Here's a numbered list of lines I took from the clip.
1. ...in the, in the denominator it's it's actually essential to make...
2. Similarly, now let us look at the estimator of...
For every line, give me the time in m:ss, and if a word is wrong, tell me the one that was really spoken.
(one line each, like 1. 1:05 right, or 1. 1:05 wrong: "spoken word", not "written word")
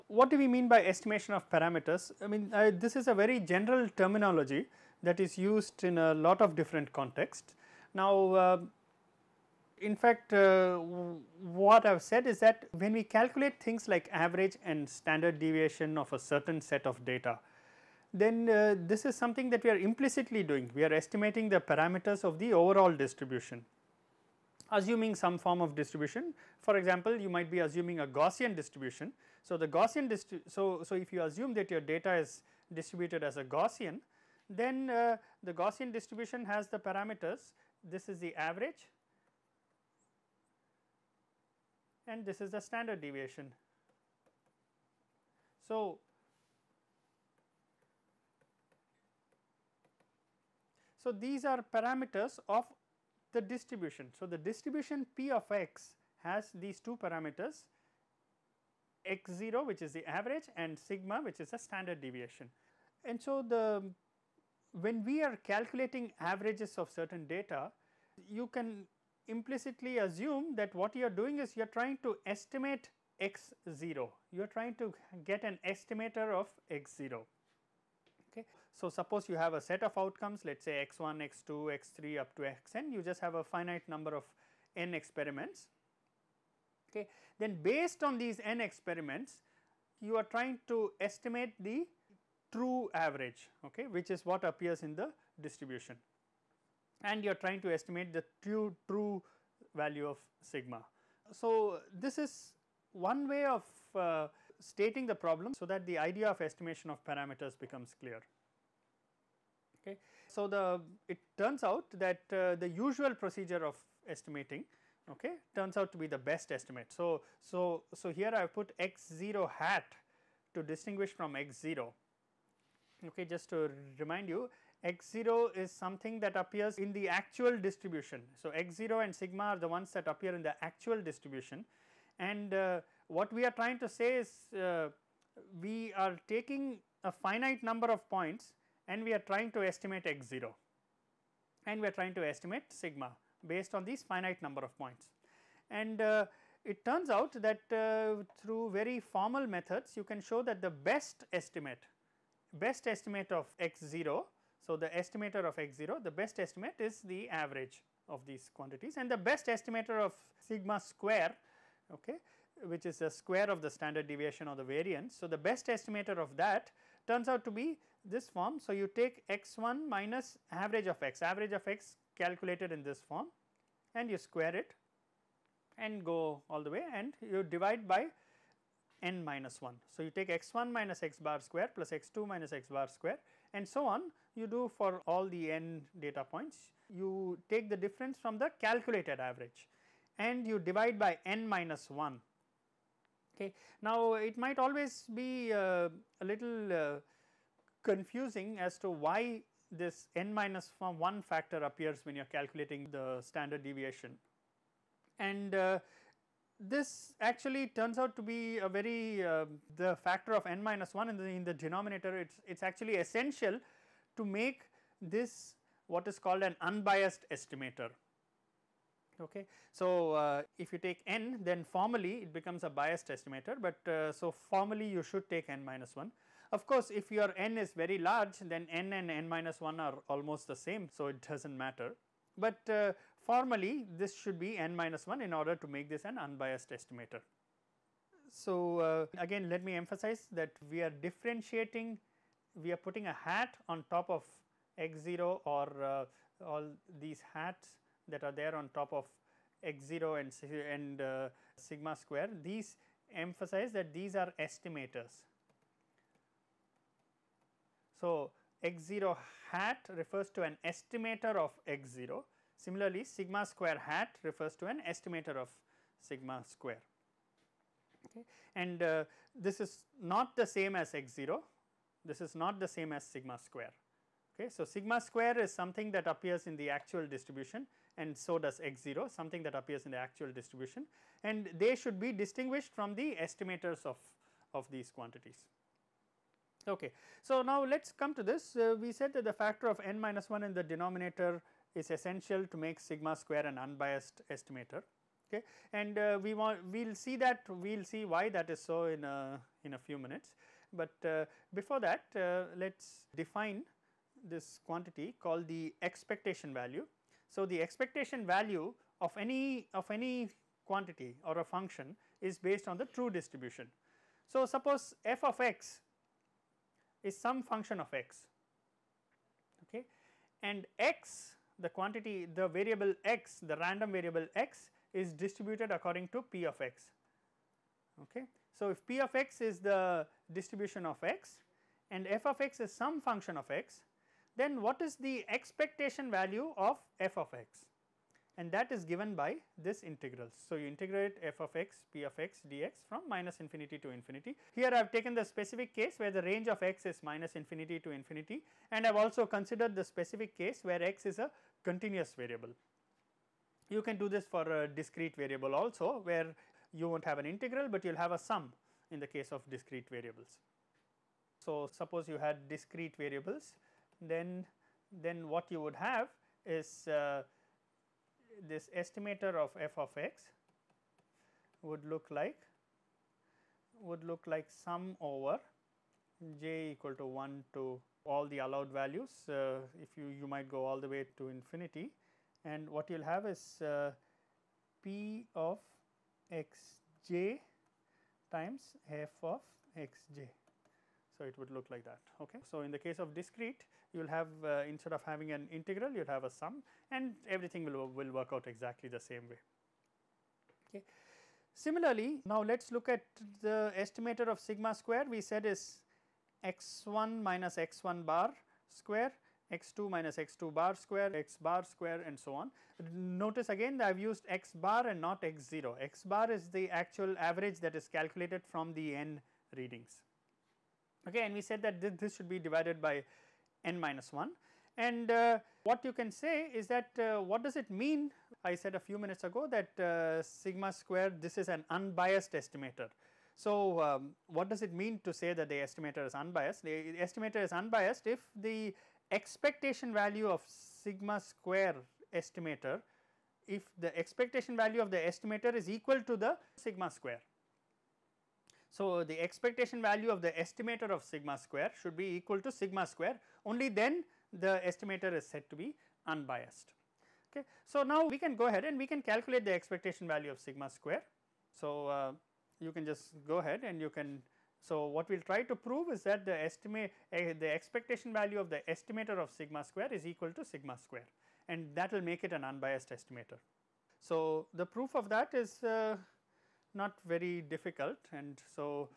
1. 3:31 right
2. 6:41 right.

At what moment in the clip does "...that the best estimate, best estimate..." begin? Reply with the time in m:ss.
2:30.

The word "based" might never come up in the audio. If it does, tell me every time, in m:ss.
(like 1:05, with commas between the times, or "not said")
1:27, 2:23, 5:12.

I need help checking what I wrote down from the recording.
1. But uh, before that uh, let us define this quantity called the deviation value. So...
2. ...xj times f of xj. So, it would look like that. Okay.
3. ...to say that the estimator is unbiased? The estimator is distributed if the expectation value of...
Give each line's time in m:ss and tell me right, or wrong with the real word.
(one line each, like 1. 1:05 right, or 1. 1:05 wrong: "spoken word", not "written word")
1. 5:00 wrong: "expectation", not "deviation"
2. 6:26 right
3. 7:15 wrong: "unbiased", not "distributed".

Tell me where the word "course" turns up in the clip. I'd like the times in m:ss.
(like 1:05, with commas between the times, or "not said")
3:46.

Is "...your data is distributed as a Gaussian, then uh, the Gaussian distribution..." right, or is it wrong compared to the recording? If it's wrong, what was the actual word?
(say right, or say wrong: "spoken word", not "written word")
right.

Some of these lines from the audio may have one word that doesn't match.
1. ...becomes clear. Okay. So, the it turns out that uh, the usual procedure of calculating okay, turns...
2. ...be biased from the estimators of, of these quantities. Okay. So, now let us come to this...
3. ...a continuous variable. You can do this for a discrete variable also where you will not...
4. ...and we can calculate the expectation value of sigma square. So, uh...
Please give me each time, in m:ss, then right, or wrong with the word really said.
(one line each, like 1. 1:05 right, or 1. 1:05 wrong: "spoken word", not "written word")
1. 1:47 wrong: "estimating", not "calculating"
2. 4:42 wrong: "distinguished", not "biased"
3. 5:51 right
4. 7:38 right.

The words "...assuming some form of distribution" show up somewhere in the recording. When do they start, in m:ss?
0:24.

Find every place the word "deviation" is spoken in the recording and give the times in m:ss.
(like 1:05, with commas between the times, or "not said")
0:15, 0:43, 1:02, 2:44, 3:23.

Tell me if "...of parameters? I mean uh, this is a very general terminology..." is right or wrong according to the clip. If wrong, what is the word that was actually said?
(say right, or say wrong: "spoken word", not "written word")
right.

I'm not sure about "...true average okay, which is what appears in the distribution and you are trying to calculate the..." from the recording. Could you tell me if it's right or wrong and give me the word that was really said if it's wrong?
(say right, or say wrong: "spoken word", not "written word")
wrong: "estimate", not "calculate".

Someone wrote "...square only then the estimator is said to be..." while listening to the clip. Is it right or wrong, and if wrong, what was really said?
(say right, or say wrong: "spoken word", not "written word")
right.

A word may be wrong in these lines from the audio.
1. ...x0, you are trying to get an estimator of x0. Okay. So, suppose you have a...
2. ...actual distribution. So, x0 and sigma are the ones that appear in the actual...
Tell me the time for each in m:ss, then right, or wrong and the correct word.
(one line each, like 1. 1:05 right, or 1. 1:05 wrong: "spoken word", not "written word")
1. 1:13 right
2. 2:07 right.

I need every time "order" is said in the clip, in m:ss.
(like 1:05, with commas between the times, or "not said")
3:55.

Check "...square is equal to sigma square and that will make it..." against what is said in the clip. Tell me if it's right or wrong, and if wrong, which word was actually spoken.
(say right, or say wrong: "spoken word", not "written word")
right.